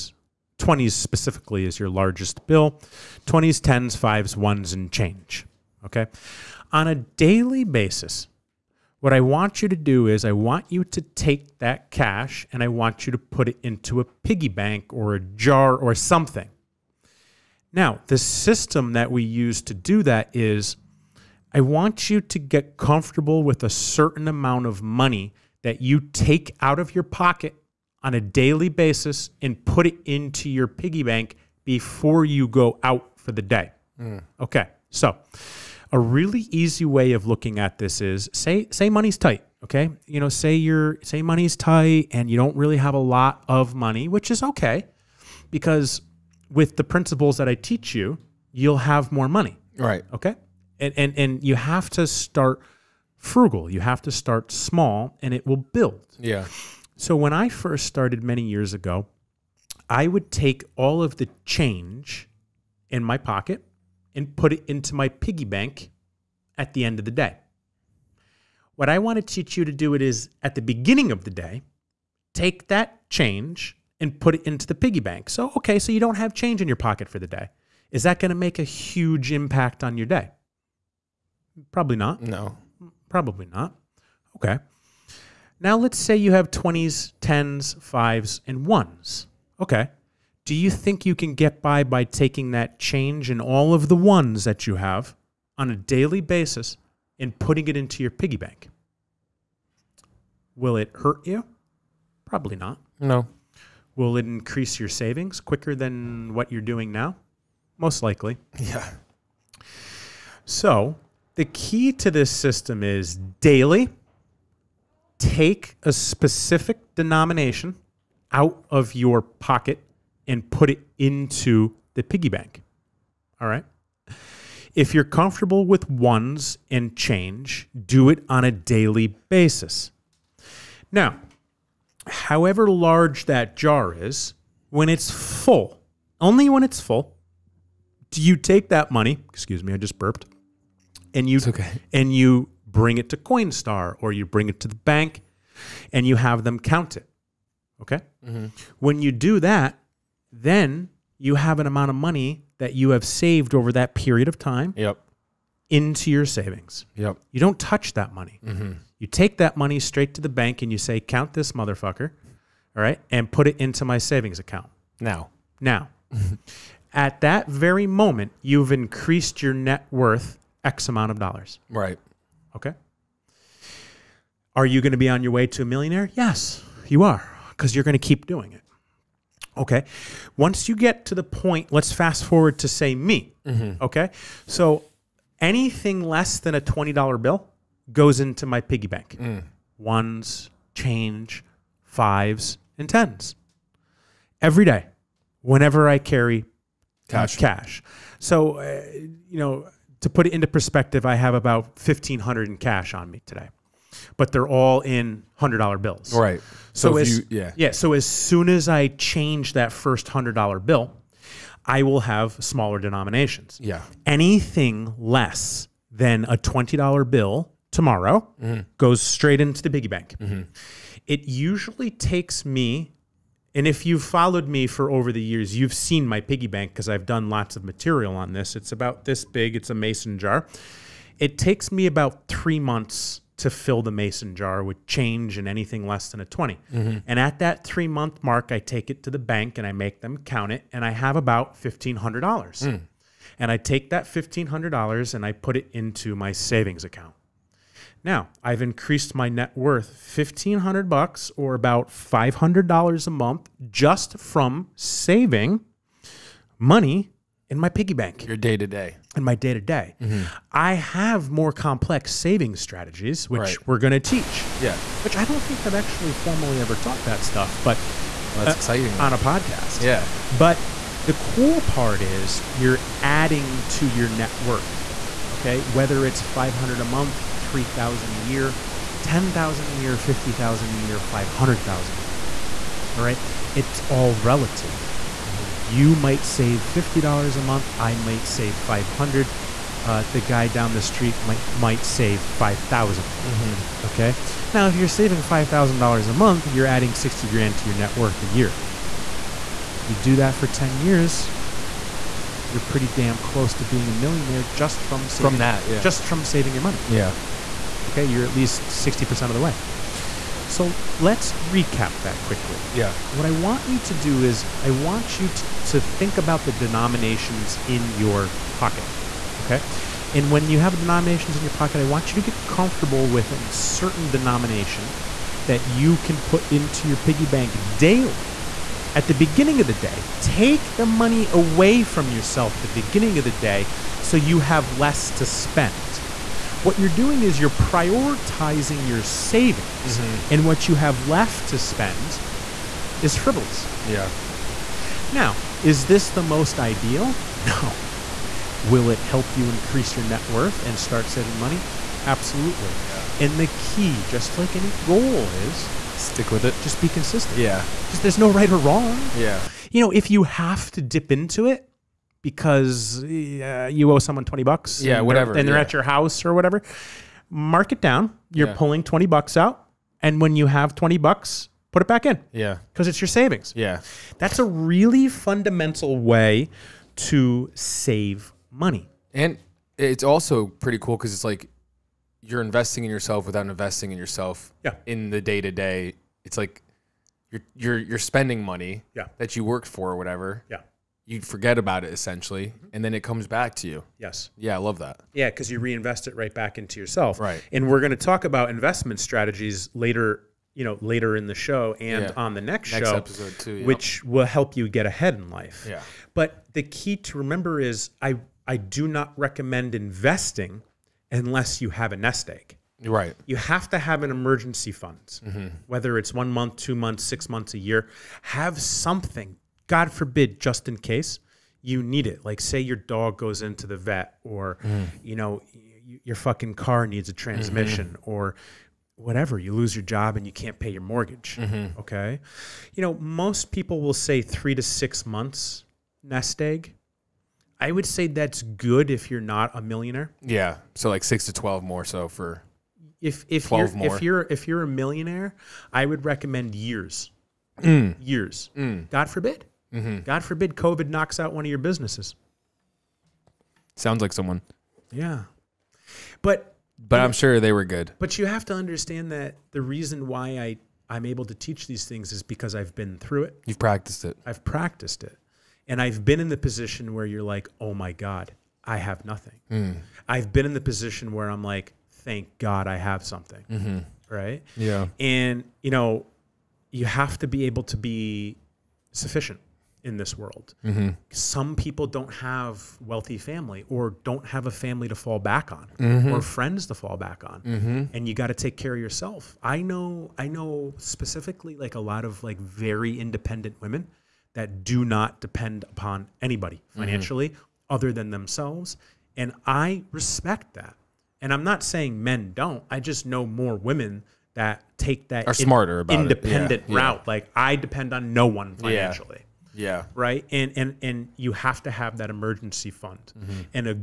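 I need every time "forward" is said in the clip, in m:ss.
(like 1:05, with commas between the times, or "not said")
3:02.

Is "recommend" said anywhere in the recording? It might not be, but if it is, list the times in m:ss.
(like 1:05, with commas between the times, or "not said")
6:49, 7:26.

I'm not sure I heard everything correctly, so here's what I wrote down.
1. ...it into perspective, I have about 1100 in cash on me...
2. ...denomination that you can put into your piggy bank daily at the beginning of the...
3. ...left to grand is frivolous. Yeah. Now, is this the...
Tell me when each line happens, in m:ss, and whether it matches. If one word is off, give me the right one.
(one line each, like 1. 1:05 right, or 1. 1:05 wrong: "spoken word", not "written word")
1. 3:20 wrong: "1500", not "1100"
2. 5:24 right
3. 5:41 wrong: "spend", not "grand".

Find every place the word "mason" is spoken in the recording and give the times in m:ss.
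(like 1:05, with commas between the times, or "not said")
3:49, 3:53.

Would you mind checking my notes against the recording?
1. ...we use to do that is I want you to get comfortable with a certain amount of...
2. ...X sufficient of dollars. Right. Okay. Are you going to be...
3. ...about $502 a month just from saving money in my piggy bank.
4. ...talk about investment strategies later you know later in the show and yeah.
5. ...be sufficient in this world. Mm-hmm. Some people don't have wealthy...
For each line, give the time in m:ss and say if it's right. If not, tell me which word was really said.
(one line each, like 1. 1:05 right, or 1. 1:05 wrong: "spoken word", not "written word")
1. 0:19 right
2. 2:50 wrong: "amount", not "sufficient"
3. 4:11 wrong: "500", not "502"
4. 6:37 right
5. 7:57 right.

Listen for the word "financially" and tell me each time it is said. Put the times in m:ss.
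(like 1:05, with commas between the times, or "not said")
8:16, 8:28.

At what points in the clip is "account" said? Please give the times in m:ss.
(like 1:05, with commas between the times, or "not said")
2:44, 4:06.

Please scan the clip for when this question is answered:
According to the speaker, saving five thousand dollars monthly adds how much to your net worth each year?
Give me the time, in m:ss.
4:56.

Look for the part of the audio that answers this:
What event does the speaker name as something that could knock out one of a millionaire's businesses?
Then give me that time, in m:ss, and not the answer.
7:30.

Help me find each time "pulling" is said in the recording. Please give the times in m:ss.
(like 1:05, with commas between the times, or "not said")
6:08.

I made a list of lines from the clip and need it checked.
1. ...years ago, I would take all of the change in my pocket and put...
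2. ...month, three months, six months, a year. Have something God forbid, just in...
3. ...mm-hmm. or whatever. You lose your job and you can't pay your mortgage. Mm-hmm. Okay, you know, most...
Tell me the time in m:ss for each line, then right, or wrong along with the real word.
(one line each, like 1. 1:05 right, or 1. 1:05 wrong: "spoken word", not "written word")
1. 0:58 right
2. 6:56 wrong: "two", not "three"
3. 7:07 right.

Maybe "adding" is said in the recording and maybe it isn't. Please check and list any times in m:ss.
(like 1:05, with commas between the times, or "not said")
4:33, 4:56.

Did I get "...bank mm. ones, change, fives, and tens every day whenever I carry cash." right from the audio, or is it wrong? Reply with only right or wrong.
right.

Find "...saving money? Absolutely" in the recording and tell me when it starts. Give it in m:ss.
5:51.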